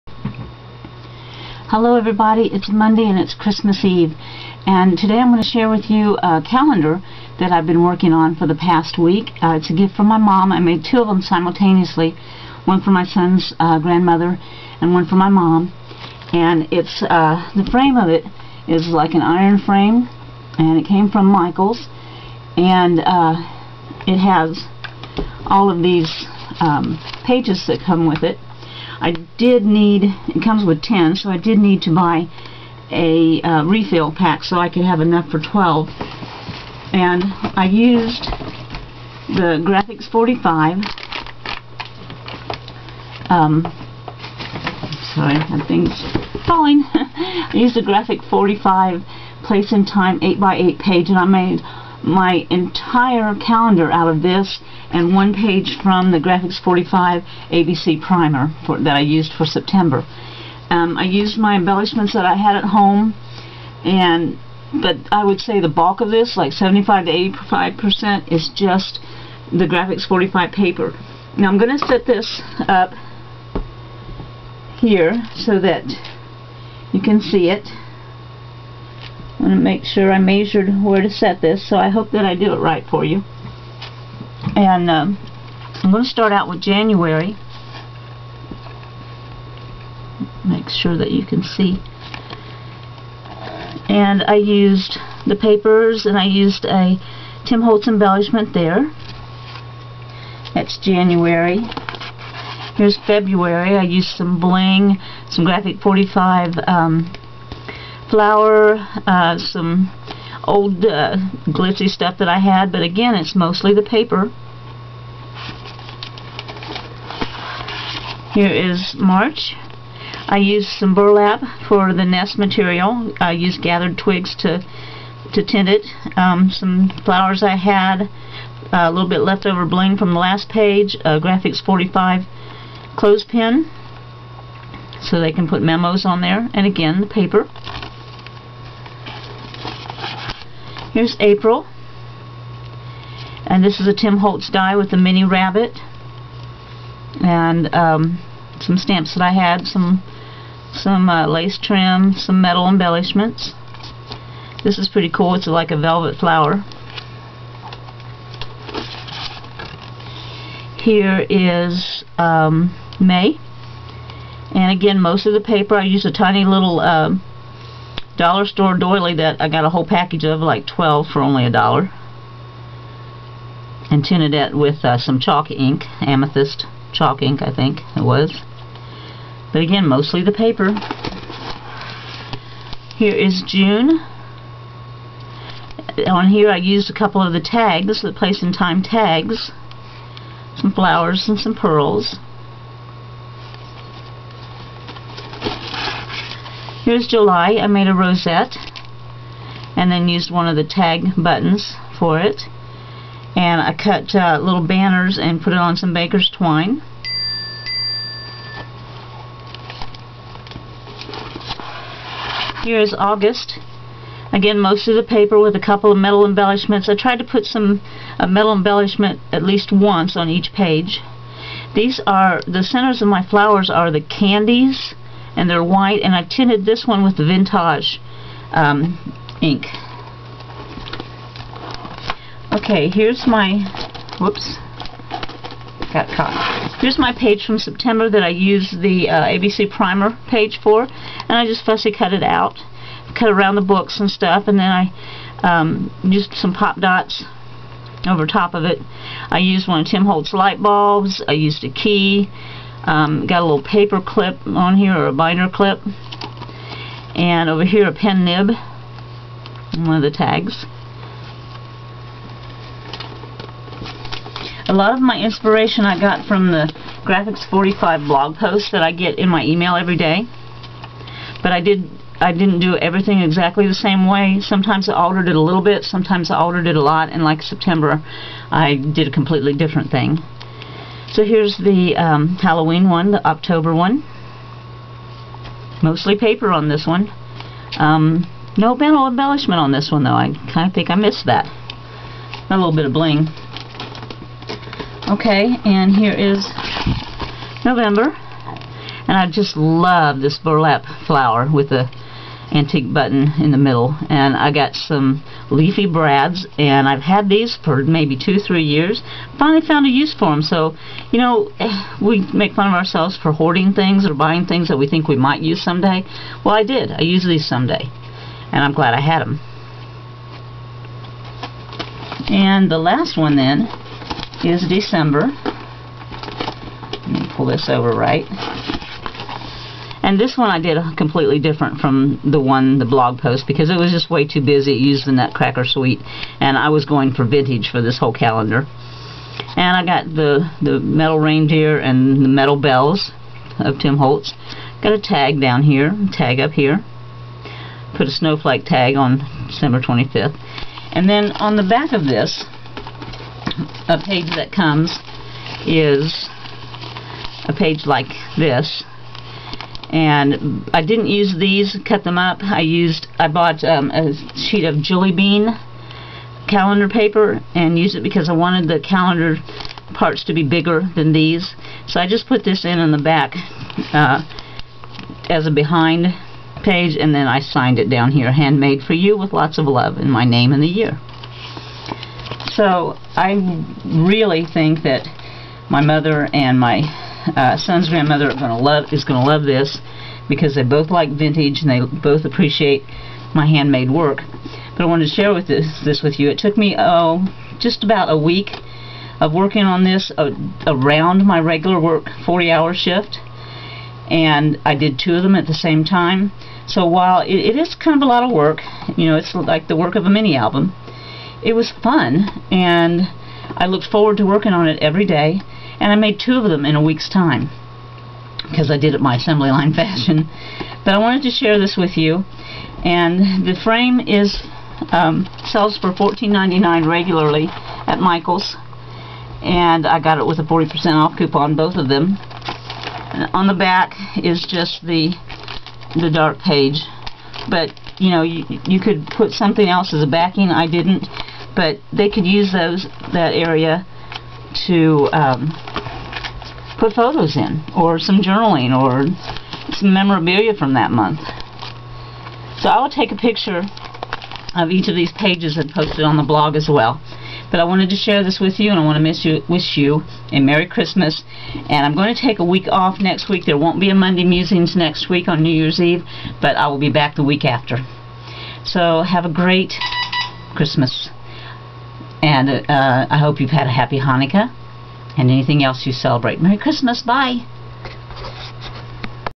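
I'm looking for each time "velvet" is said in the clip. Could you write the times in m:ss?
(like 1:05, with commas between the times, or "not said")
2:35.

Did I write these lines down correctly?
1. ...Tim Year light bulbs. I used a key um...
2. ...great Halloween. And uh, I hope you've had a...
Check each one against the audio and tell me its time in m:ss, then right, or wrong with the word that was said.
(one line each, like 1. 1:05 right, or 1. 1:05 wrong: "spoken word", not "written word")
1. 4:09 wrong: "Holtz", not "Year"
2. 7:49 wrong: "Christmas", not "Halloween".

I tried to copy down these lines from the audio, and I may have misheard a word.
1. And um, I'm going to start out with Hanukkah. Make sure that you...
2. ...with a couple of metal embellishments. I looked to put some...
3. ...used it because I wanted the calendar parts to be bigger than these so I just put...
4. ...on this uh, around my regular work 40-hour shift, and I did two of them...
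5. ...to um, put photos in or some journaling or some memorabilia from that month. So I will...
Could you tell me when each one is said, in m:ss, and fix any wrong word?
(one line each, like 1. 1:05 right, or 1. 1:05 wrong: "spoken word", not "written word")
1. 1:24 wrong: "January", not "Hanukkah"
2. 3:35 wrong: "tried", not "looked"
3. 6:07 right
4. 6:39 right
5. 7:24 right.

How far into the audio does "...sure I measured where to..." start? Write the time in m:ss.
1:19.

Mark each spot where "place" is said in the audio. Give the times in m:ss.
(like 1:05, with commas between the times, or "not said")
0:49, 3:08.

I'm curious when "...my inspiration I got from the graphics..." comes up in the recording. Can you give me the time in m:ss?
4:25.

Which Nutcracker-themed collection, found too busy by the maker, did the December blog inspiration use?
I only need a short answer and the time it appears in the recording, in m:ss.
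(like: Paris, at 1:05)
Nutcracker Suite, at 5:35.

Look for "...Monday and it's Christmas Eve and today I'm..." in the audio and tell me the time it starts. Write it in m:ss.
0:02.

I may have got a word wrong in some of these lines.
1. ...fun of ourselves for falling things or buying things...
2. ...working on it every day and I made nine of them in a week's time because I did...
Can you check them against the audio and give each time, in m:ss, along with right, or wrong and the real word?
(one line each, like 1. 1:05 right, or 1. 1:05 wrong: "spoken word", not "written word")
1. 5:12 wrong: "hoarding", not "falling"
2. 6:54 wrong: "two", not "nine".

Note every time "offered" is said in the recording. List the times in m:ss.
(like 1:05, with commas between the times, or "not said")
not said.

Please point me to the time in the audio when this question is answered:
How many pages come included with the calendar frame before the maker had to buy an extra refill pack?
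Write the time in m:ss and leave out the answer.
0:30.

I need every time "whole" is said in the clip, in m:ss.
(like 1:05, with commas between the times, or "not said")
2:49, 5:37.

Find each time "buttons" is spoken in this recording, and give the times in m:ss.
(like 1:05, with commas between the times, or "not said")
3:21, 5:02.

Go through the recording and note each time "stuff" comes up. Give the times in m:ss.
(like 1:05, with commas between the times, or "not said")
1:51, 4:04.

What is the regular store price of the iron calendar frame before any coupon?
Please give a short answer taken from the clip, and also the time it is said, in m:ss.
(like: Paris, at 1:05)
$14.99, at 7:05.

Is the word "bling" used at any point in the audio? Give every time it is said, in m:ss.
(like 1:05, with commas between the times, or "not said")
1:44, 2:09, 4:52.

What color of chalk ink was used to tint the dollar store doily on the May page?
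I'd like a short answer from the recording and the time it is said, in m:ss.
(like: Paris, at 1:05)
amethyst, at 2:56.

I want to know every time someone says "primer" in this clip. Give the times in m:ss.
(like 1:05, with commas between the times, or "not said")
0:58, 3:59.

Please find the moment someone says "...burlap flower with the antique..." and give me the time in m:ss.
5:00.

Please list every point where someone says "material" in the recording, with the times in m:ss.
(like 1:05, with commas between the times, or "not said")
2:02.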